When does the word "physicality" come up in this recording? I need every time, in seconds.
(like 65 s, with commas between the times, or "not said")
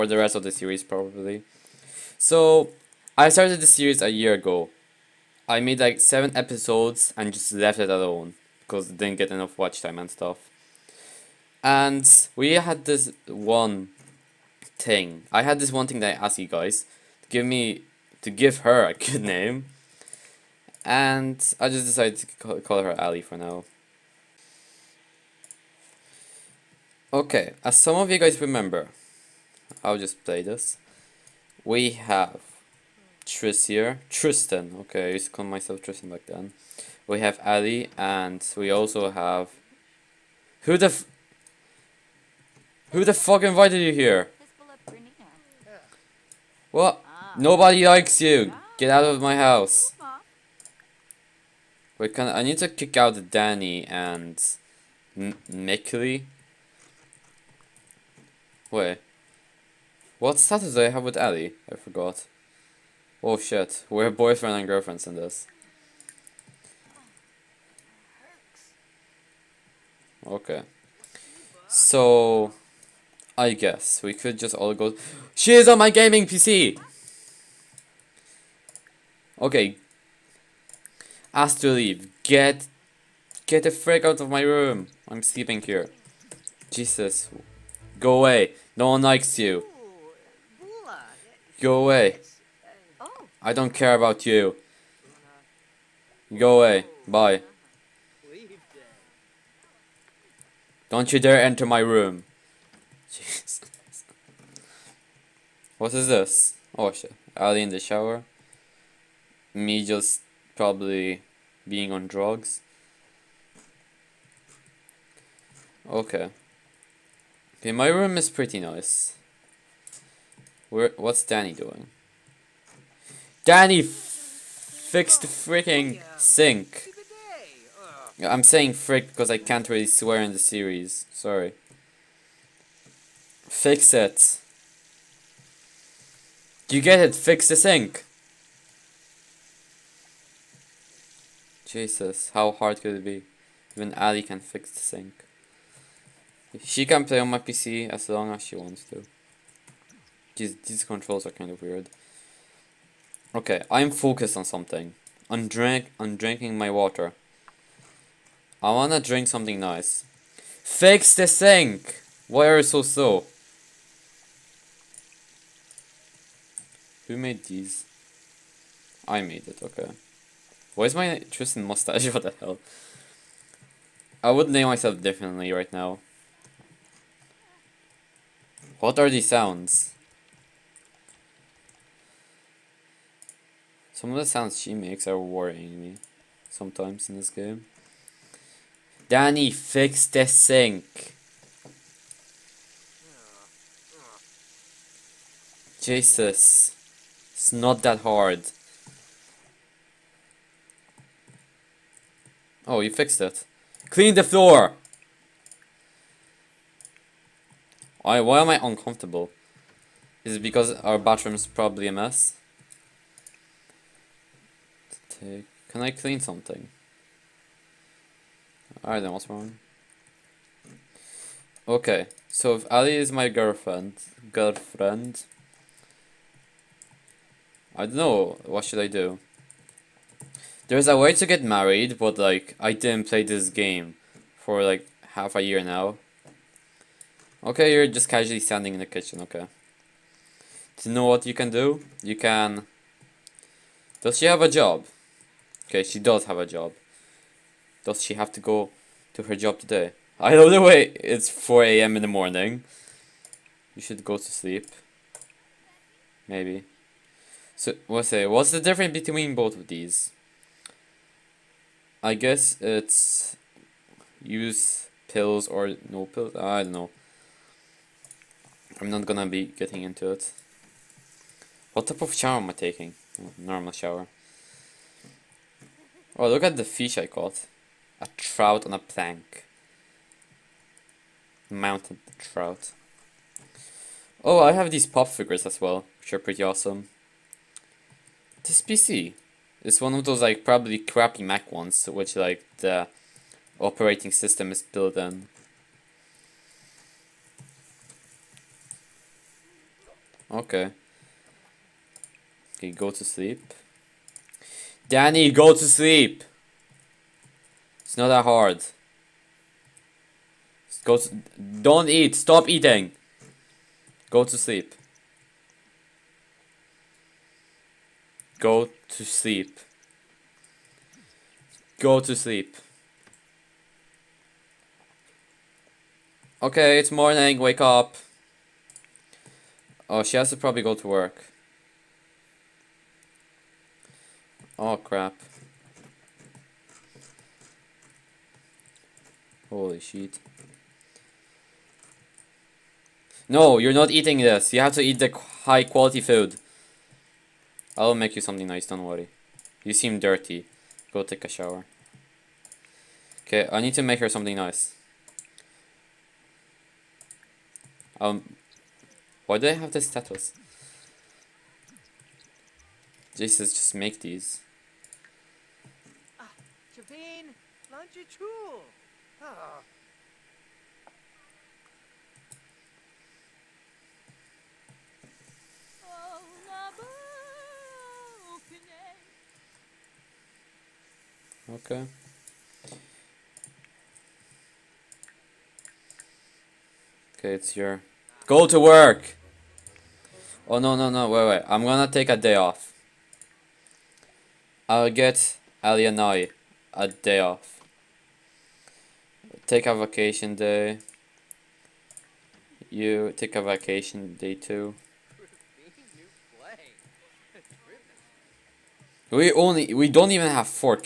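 not said.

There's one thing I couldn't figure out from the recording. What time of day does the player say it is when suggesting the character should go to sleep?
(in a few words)
4 a.m.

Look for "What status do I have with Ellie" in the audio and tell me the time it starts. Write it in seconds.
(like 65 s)
60 s.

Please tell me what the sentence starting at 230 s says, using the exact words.
There's a way to get married, but like, I didn't play this game for like half a year now.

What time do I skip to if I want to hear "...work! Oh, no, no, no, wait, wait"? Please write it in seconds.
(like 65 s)
388 s.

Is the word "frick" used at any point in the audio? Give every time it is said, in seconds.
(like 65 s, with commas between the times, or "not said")
83 s, 128 s.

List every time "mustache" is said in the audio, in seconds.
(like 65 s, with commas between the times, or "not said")
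171 s.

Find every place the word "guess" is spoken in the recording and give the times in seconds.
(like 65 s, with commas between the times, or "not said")
73 s, 262 s.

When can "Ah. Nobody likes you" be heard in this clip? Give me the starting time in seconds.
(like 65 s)
47 s.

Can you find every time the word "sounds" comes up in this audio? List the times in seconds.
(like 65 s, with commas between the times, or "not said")
179 s, 184 s.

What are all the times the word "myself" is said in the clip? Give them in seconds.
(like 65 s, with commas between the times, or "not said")
35 s, 174 s.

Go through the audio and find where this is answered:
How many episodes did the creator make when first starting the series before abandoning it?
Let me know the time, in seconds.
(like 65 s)
5 s.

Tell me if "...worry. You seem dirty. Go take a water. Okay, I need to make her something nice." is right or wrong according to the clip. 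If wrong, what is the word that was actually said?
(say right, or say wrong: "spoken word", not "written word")
wrong: "shower", not "water".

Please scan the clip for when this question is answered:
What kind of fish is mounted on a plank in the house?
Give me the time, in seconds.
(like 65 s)
281 s.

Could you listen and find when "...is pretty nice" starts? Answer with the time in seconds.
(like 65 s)
118 s.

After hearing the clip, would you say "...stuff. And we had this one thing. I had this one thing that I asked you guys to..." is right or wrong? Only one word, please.
right.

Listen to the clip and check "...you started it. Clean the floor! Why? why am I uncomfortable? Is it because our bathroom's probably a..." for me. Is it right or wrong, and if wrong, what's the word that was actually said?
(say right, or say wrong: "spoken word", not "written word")
wrong: "fixed", not "started".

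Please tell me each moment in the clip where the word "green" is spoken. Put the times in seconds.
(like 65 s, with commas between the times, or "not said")
not said.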